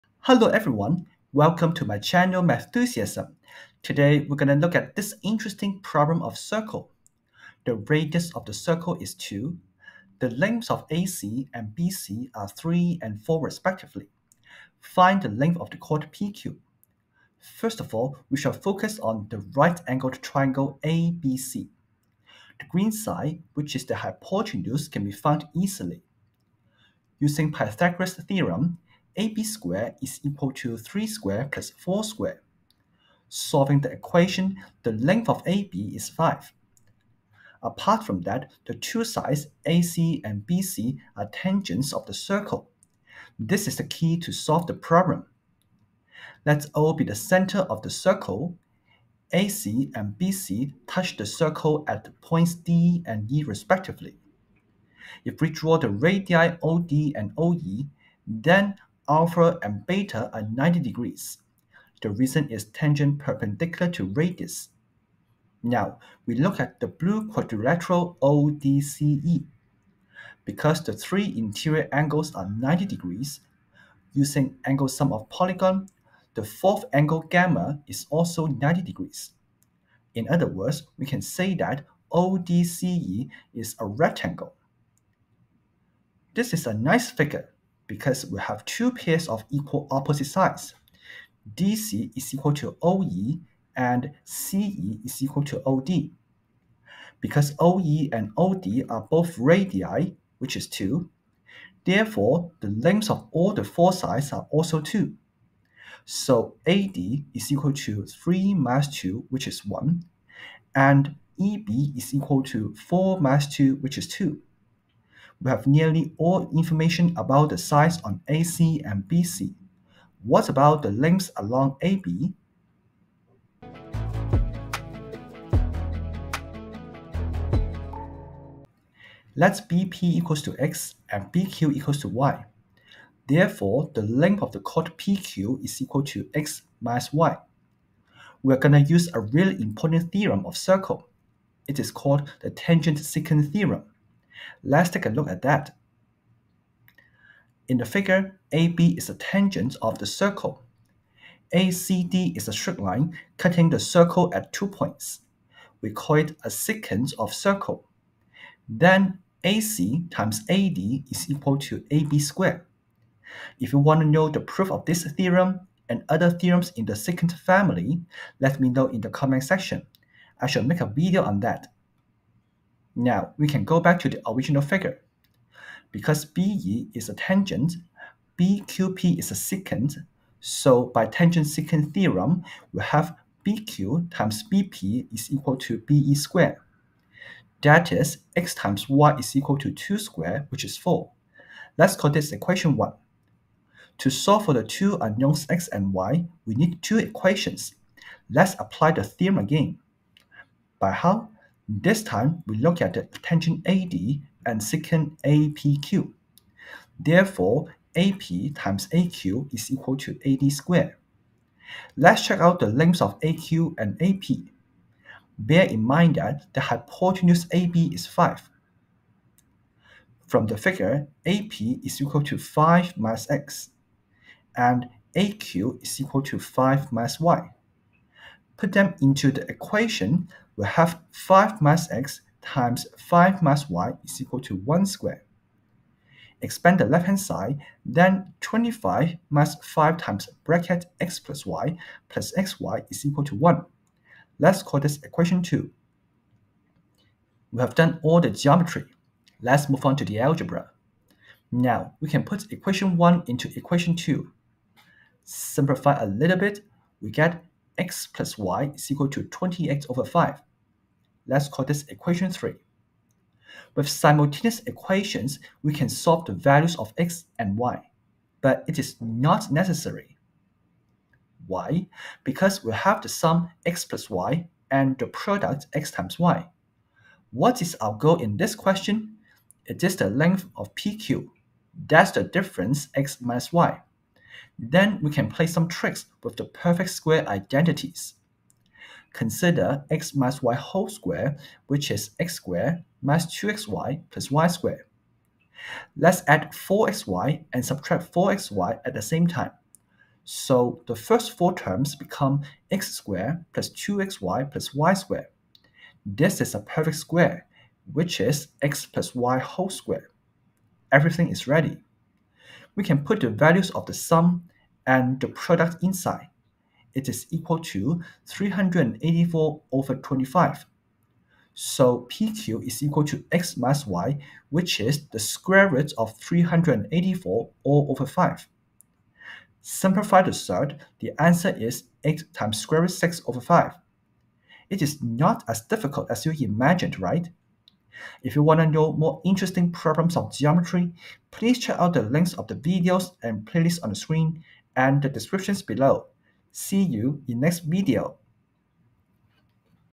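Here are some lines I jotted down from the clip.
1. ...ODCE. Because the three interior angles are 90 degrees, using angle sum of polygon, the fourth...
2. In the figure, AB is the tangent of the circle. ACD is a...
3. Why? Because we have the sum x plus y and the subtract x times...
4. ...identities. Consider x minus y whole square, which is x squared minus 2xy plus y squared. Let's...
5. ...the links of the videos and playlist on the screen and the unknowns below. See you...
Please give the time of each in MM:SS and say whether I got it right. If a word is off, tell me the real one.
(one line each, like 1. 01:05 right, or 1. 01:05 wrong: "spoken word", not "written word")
1. 01:08 right
2. 02:27 right
3. 04:31 wrong: "product", not "subtract"
4. 04:47 right
5. 05:41 wrong: "descriptions", not "unknowns".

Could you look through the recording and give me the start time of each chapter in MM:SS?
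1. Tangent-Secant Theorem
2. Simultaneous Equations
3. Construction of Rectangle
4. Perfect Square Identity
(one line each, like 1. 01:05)
1. 02:08
2. 02:52
3. 00:37
4. 04:31.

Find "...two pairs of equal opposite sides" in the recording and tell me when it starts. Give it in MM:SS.
01:28.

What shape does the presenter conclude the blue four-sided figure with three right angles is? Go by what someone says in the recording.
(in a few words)
rectangle.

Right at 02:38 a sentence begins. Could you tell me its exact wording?
Then AC times AD is equal to AB squared.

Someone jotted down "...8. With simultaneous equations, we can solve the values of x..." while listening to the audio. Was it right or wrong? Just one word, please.
wrong.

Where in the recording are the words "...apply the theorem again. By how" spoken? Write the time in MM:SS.
03:18.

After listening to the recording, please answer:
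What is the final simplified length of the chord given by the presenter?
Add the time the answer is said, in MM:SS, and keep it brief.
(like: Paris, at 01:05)
8√6/5, at 05:32.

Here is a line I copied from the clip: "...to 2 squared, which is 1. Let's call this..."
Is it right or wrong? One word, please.
wrong.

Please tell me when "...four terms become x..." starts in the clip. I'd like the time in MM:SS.
05:01.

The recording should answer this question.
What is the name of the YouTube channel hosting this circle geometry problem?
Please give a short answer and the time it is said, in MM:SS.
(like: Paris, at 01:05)
Mathusiasm, at 00:02.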